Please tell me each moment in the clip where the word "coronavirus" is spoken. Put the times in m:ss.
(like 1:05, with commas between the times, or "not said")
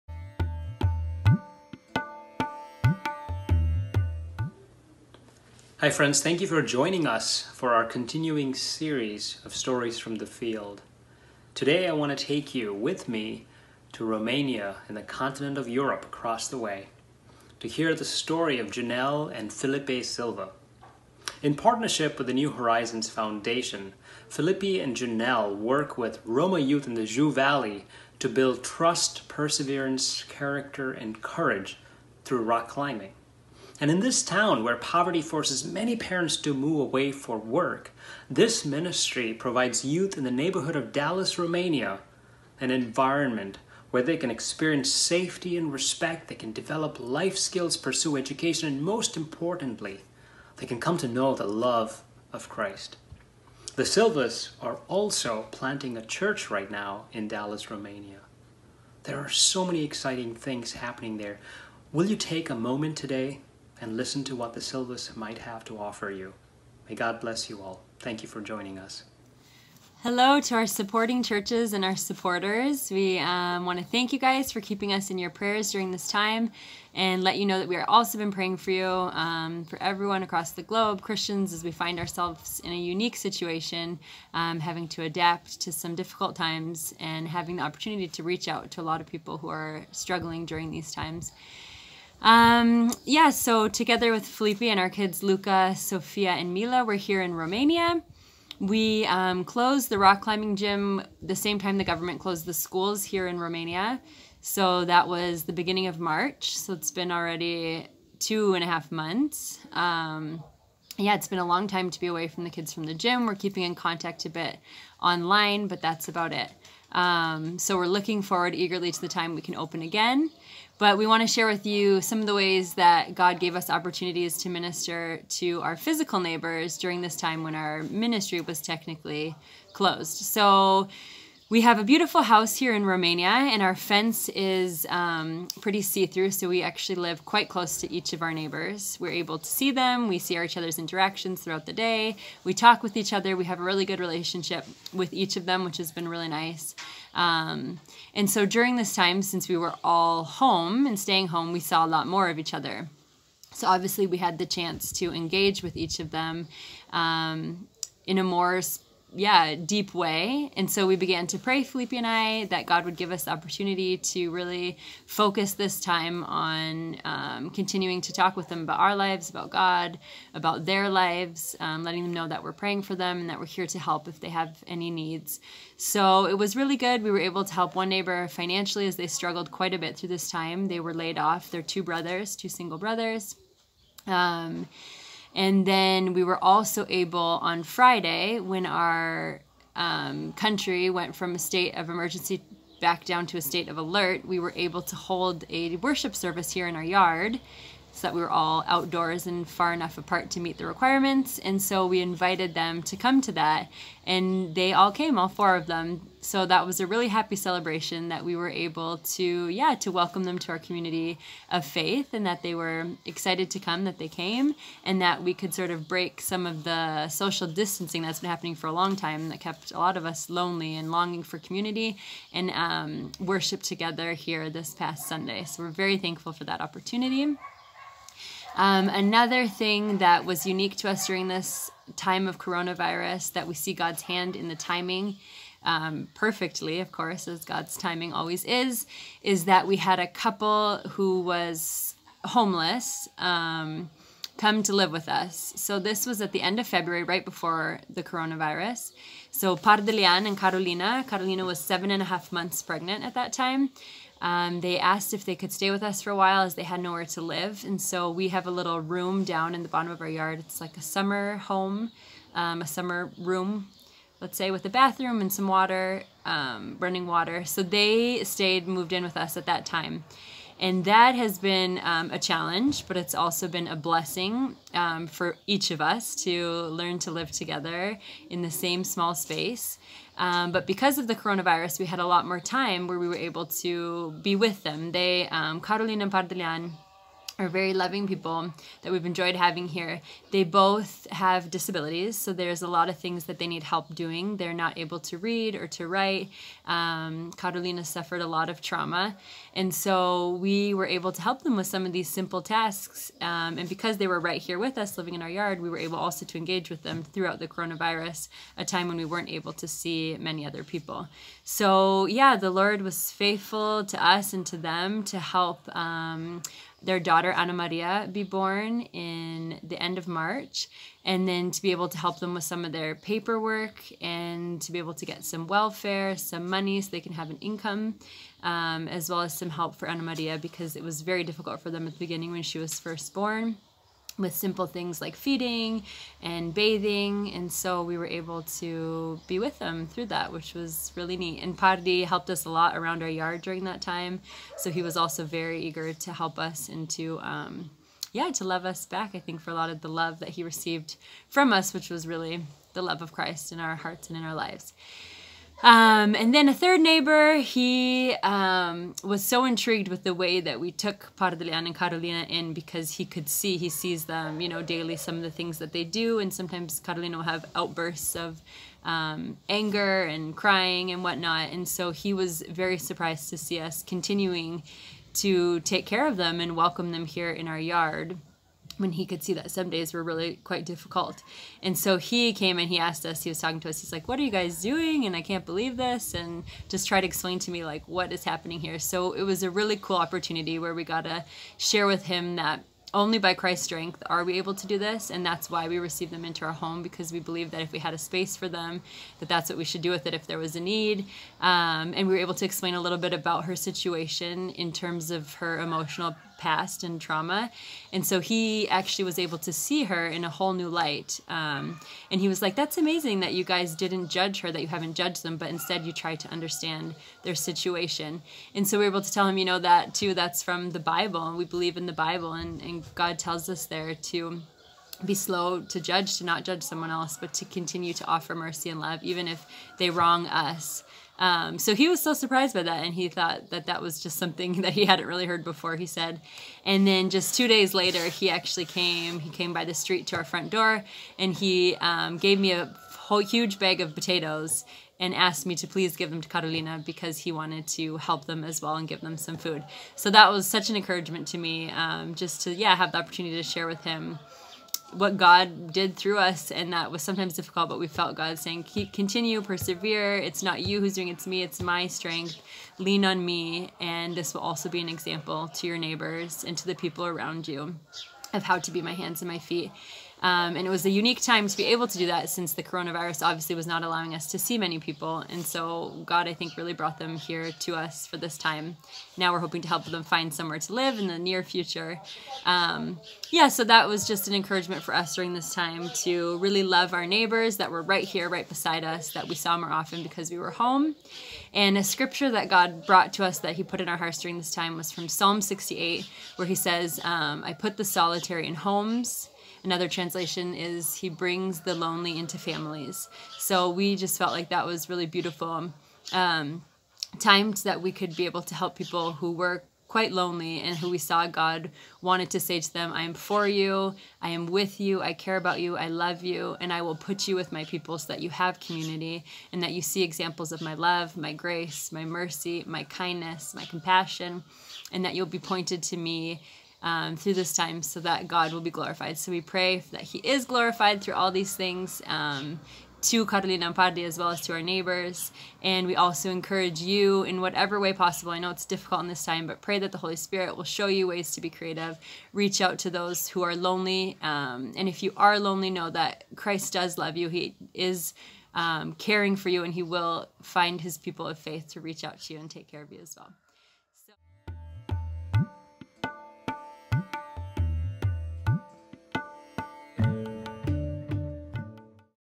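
3:52, 4:08, 4:41, 5:07, 7:52.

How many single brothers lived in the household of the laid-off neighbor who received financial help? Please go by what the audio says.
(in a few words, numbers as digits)
2.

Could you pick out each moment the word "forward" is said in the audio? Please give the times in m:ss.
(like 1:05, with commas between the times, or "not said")
1:58.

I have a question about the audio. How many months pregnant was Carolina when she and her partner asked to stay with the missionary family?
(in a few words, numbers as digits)
7.5.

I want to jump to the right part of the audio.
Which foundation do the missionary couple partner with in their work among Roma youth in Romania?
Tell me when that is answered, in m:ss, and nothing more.
0:22.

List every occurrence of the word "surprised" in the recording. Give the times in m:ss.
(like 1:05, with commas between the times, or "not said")
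6:12, 7:12.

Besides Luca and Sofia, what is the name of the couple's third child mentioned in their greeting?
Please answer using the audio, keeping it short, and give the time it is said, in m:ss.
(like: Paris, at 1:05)
Mila, at 1:36.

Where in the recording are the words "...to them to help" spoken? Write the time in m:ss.
5:14.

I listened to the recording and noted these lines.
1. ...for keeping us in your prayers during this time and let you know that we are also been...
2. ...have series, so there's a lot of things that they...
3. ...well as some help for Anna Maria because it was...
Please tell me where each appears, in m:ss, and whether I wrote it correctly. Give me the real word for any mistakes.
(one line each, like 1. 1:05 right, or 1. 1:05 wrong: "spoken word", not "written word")
1. 1:14 right
2. 4:51 wrong: "disabilities", not "series"
3. 5:29 right.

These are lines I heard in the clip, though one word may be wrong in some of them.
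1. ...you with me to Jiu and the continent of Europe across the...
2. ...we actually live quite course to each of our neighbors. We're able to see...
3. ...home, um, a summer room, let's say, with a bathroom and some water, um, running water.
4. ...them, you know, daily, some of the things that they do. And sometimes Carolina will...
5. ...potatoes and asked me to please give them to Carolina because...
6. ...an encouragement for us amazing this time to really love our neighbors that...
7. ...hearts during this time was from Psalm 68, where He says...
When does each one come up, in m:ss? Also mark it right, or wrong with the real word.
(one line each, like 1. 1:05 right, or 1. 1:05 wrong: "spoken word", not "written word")
1. 0:12 wrong: "Romania", not "Jiu"
2. 2:16 wrong: "close", not "course"
3. 4:21 right
4. 6:04 right
5. 7:23 right
6. 8:04 wrong: "during", not "amazing"
7. 8:13 right.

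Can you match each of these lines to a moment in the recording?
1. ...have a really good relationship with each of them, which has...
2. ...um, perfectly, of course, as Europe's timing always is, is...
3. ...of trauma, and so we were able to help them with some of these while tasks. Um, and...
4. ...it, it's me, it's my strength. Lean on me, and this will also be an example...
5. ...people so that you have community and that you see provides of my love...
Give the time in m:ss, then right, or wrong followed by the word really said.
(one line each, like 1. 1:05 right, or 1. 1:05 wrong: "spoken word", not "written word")
1. 2:23 right
2. 3:55 wrong: "God", not "Europe"
3. 4:58 wrong: "simple", not "while"
4. 7:41 right
5. 8:37 wrong: "examples", not "provides".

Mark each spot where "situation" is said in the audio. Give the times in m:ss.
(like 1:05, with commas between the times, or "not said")
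1:23, 6:43, 6:57.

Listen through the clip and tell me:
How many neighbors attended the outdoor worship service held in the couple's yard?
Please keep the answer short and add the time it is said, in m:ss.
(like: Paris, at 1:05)
4, at 3:25.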